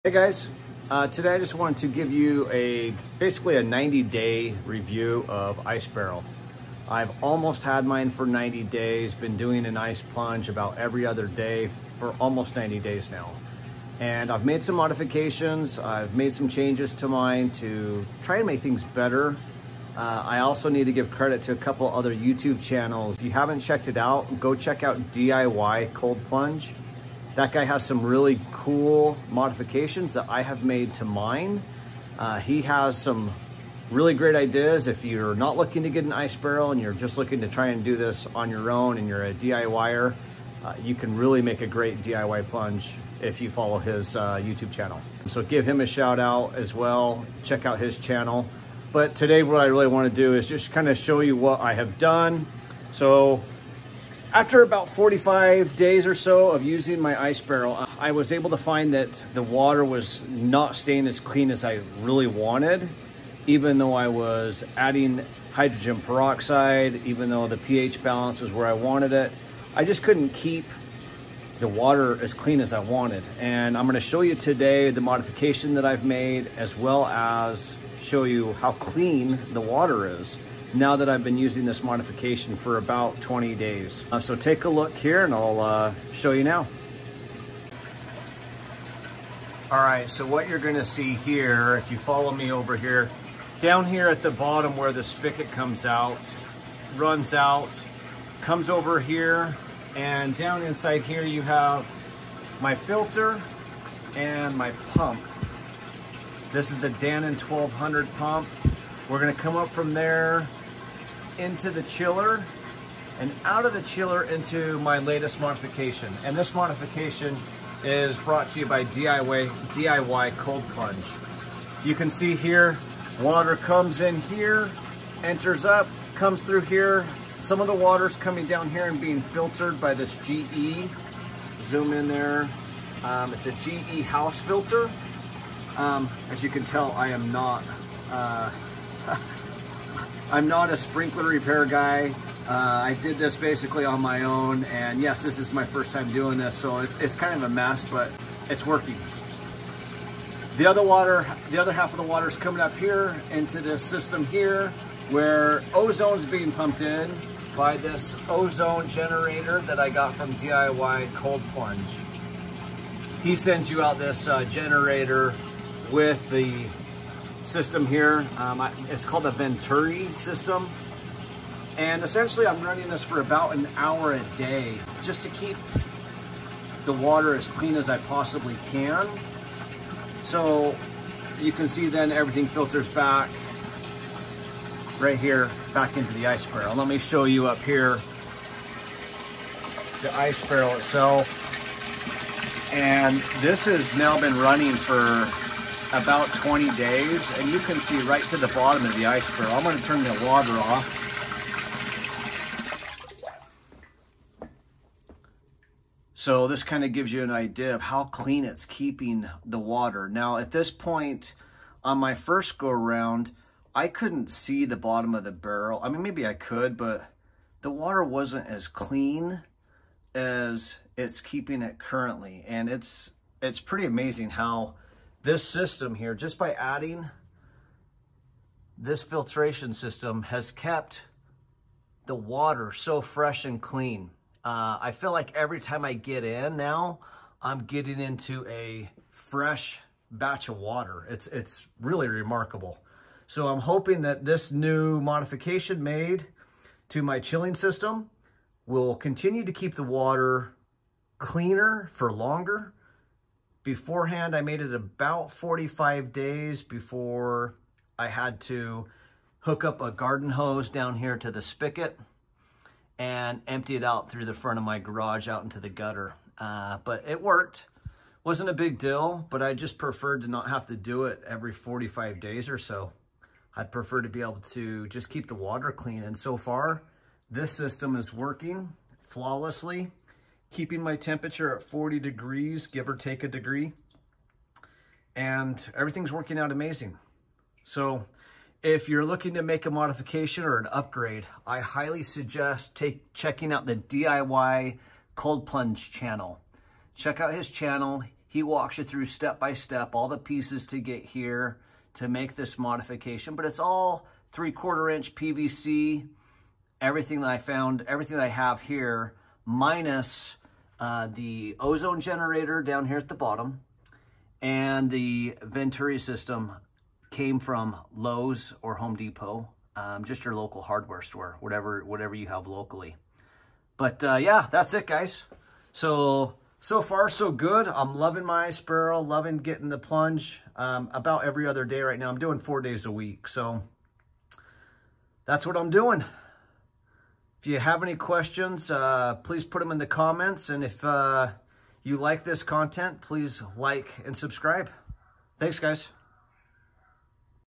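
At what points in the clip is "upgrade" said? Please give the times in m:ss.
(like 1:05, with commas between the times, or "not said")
4:50.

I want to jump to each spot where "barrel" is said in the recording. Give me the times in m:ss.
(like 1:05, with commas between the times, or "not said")
0:05, 0:36, 0:57, 3:06, 3:10, 3:19, 3:35, 5:28.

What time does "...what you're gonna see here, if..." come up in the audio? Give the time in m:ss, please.
1:30.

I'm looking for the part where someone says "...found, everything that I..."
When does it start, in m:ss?
5:07.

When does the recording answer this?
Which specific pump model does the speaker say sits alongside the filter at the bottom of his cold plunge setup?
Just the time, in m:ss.
1:46.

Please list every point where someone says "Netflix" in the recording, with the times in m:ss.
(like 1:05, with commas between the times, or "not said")
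not said.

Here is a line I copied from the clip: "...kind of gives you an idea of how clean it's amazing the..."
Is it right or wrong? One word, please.
wrong.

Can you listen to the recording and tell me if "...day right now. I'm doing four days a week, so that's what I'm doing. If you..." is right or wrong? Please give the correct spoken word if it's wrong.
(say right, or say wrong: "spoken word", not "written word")
right.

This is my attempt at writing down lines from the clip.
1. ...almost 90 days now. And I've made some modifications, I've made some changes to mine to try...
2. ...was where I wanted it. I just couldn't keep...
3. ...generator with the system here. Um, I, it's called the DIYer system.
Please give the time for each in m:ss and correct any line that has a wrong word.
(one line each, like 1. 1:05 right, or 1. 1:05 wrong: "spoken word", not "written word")
1. 0:12 right
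2. 1:08 right
3. 2:44 wrong: "Venturi", not "DIYer".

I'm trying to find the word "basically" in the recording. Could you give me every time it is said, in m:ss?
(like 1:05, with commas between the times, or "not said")
0:03, 2:23.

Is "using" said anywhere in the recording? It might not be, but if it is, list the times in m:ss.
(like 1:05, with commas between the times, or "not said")
0:56, 1:21.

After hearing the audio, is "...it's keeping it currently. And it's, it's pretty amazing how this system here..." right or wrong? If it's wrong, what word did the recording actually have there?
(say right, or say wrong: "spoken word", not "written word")
right.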